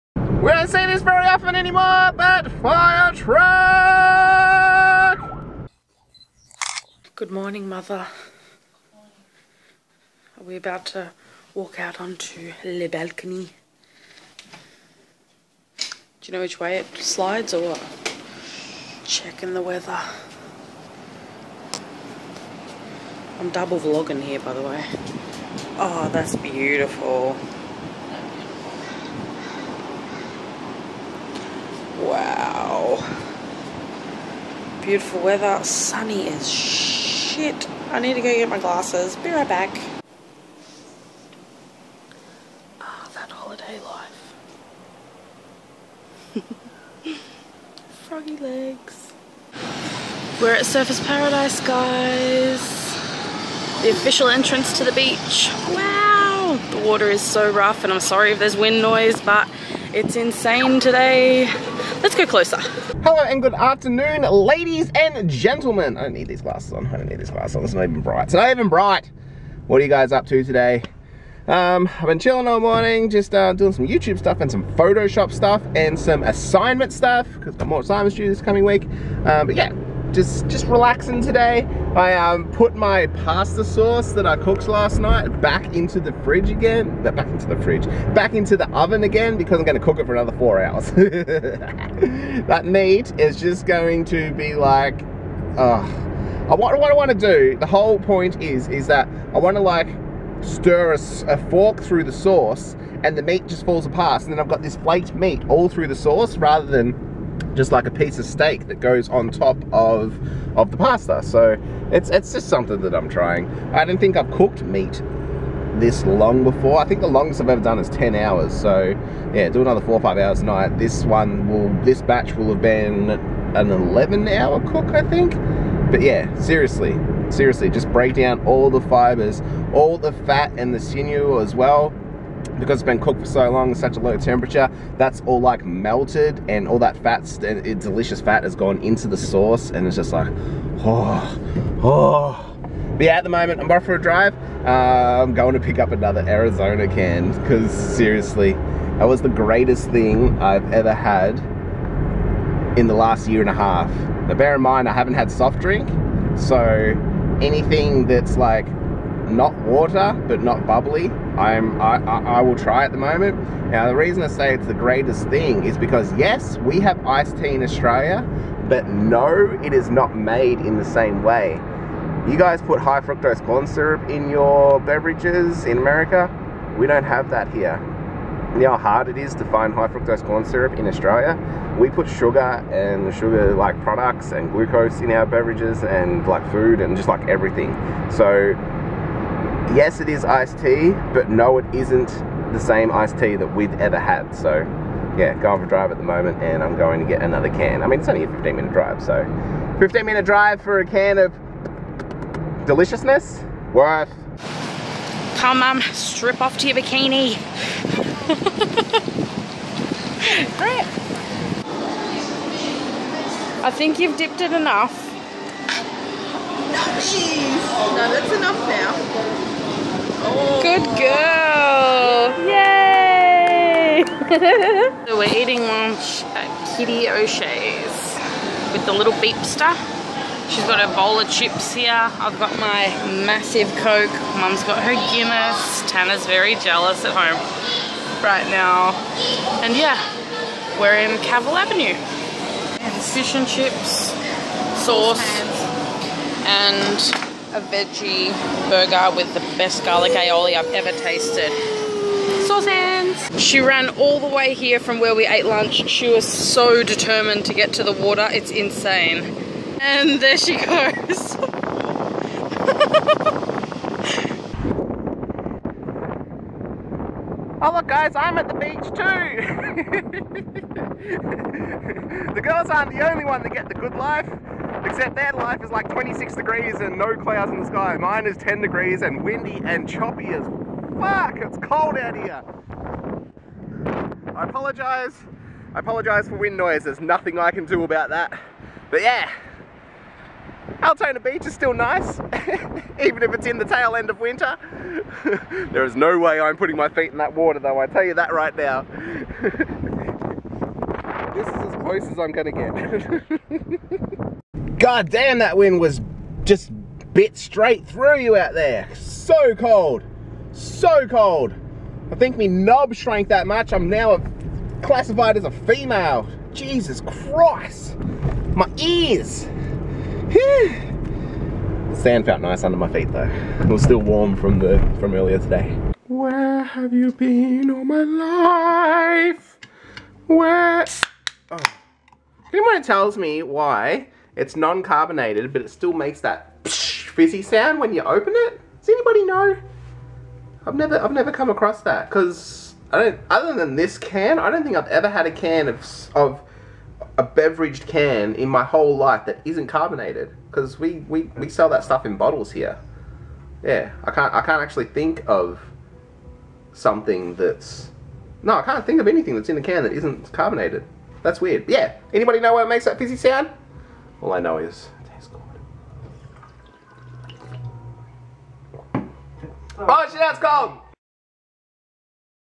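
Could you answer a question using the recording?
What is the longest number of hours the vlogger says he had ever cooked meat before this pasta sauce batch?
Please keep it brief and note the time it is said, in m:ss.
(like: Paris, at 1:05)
10 hours, at 1:57.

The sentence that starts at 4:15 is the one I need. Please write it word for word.
She was so determined to get to the water.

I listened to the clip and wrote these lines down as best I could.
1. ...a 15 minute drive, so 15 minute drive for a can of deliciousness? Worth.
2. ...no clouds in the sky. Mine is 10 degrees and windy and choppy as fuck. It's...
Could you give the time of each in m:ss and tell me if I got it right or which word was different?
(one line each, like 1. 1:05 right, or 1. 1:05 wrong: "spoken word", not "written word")
1. 3:18 right
2. 4:36 right.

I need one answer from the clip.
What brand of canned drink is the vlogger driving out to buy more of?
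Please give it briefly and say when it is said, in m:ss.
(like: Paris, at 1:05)
Arizona, at 2:26.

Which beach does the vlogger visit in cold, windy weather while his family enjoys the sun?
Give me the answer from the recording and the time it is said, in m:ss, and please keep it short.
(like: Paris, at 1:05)
Altona Beach, at 4:50.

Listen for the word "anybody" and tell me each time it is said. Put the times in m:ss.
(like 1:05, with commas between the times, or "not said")
5:38, 6:02.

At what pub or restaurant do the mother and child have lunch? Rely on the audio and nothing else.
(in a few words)
Kitty O'Shea's.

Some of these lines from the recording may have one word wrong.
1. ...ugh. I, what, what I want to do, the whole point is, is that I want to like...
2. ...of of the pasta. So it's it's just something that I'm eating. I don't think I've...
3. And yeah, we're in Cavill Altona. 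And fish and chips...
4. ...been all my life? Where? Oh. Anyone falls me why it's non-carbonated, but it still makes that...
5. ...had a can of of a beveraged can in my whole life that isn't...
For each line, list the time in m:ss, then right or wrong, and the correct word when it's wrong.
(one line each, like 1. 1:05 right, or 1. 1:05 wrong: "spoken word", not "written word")
1. 1:35 right
2. 1:49 wrong: "trying", not "eating"
3. 3:59 wrong: "Avenue", not "Altona"
4. 5:27 wrong: "tells", not "falls"
5. 5:45 right.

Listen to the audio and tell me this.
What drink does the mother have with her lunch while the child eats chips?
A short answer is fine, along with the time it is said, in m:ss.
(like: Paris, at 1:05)
Guinness, at 3:55.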